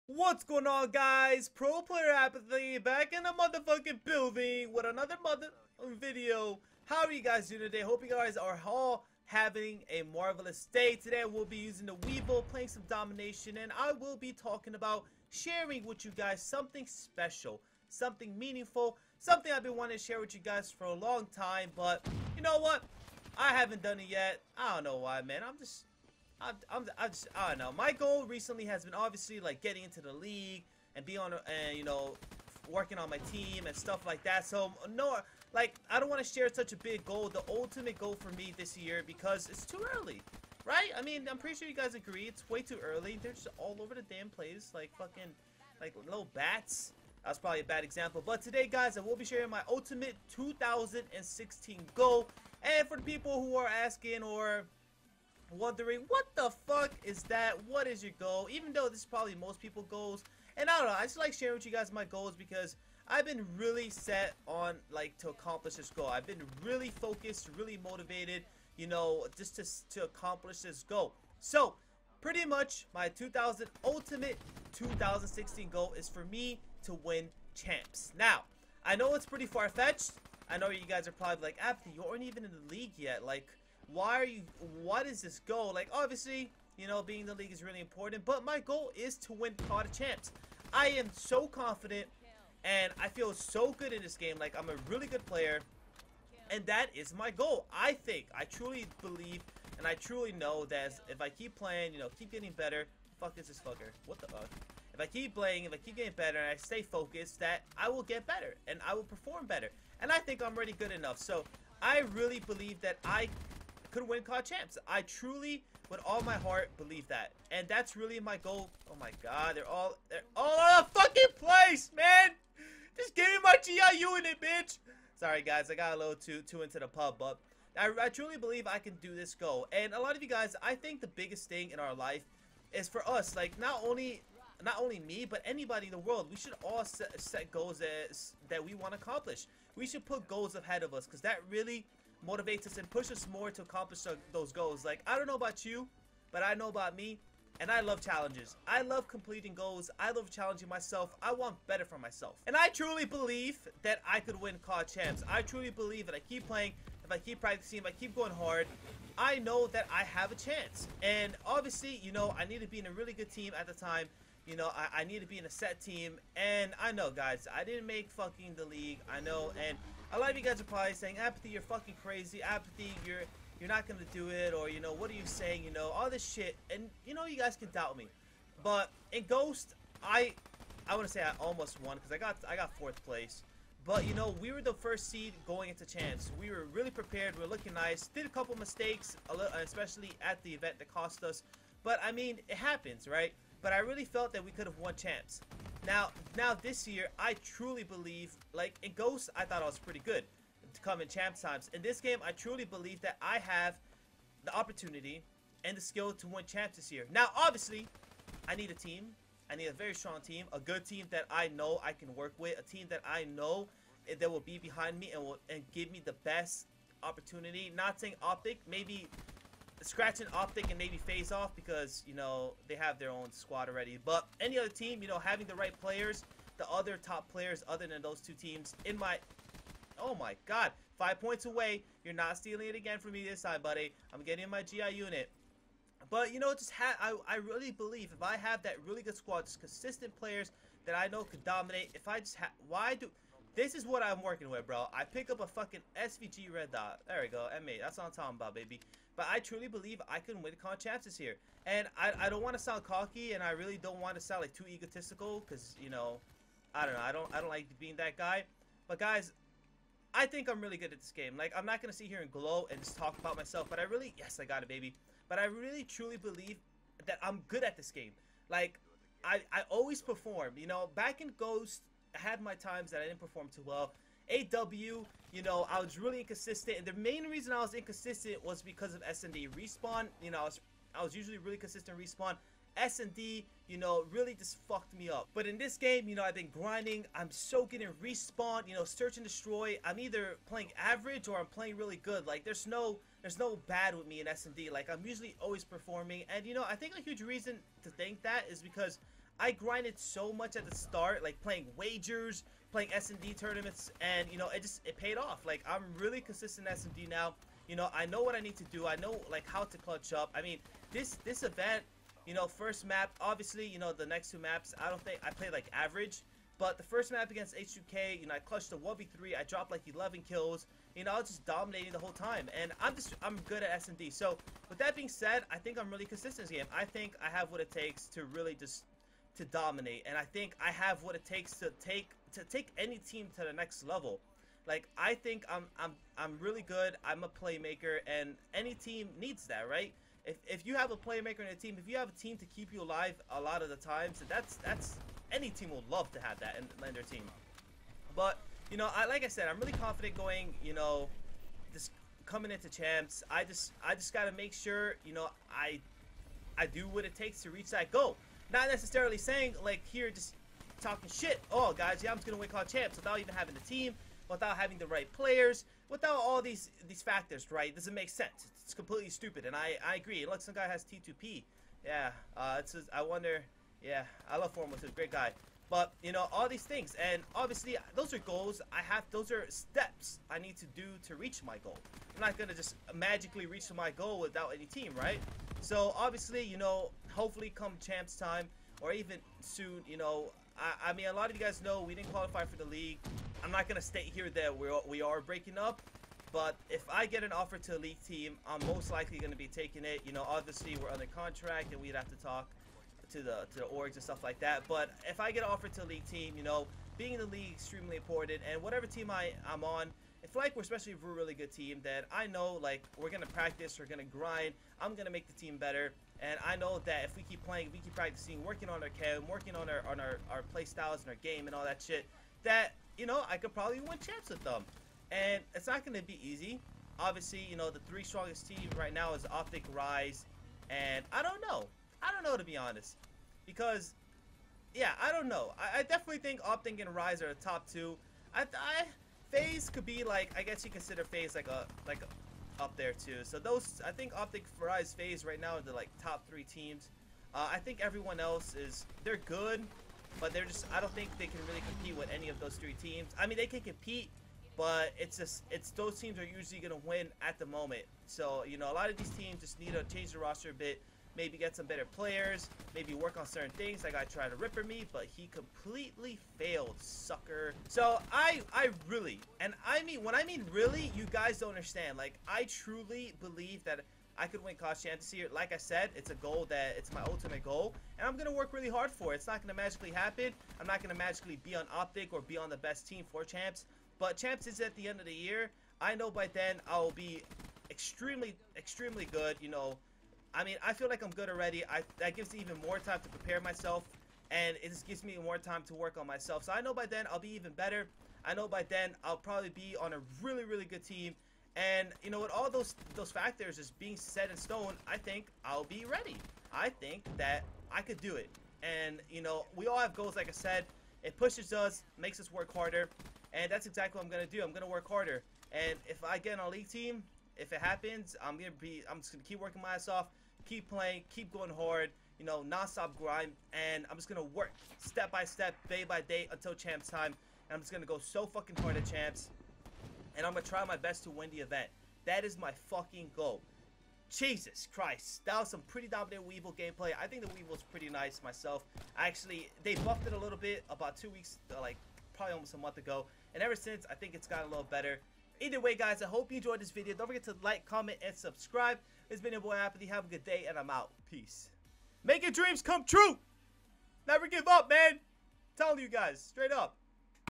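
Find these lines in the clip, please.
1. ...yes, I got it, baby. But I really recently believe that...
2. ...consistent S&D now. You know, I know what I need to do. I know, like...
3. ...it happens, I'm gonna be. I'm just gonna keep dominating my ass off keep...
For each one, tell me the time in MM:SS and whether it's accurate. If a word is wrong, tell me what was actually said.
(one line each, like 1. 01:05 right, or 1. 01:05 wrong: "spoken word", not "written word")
1. 04:24 wrong: "truly", not "recently"
2. 05:06 right
3. 08:37 wrong: "working", not "dominating".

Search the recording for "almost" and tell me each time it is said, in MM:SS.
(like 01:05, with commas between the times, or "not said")
03:01, 09:02.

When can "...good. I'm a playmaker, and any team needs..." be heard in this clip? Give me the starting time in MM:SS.
05:36.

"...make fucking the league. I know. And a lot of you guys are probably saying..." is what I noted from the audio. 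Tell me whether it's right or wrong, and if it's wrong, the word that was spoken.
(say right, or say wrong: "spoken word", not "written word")
right.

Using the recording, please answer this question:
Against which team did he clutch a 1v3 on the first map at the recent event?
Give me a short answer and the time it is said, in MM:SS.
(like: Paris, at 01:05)
H2K, at 05:17.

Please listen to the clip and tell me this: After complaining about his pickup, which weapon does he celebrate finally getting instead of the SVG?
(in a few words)
M8.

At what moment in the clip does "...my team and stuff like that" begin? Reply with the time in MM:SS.
00:33.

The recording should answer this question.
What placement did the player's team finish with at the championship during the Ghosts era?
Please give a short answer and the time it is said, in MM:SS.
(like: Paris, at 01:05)
Fourth place, at 03:02.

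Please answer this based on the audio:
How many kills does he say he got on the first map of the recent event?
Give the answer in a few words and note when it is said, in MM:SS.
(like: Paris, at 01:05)
11, at 05:19.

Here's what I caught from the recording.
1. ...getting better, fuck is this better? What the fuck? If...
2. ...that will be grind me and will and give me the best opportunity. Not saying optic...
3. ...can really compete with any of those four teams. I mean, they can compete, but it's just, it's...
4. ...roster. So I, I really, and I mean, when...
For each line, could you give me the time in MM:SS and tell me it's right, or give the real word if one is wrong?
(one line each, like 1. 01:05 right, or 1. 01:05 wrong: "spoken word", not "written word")
1. 01:42 wrong: "fucker", not "better"
2. 03:34 wrong: "behind", not "grind"
3. 07:31 wrong: "three", not "four"
4. 07:46 wrong: "sucker", not "roster".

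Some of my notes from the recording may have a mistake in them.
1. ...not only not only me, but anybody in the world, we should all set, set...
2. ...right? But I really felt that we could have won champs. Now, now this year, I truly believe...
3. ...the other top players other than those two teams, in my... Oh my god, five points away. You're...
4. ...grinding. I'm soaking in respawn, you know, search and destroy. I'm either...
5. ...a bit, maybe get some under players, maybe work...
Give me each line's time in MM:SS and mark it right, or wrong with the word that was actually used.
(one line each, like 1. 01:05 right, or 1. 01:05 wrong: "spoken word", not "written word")
1. 02:13 right
2. 03:13 right
3. 03:46 right
4. 04:46 right
5. 07:40 wrong: "better", not "under".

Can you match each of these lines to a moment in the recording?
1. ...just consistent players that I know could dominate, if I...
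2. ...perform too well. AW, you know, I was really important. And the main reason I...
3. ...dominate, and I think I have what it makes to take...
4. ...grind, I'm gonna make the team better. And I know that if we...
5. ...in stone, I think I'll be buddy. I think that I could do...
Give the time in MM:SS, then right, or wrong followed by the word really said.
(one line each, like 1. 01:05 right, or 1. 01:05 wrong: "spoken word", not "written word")
1. 03:59 right
2. 04:33 wrong: "inconsistent", not "important"
3. 05:29 wrong: "takes", not "makes"
4. 06:54 right
5. 08:24 wrong: "ready", not "buddy".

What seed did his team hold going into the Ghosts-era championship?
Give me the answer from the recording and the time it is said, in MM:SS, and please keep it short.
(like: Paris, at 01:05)
First seed, at 03:04.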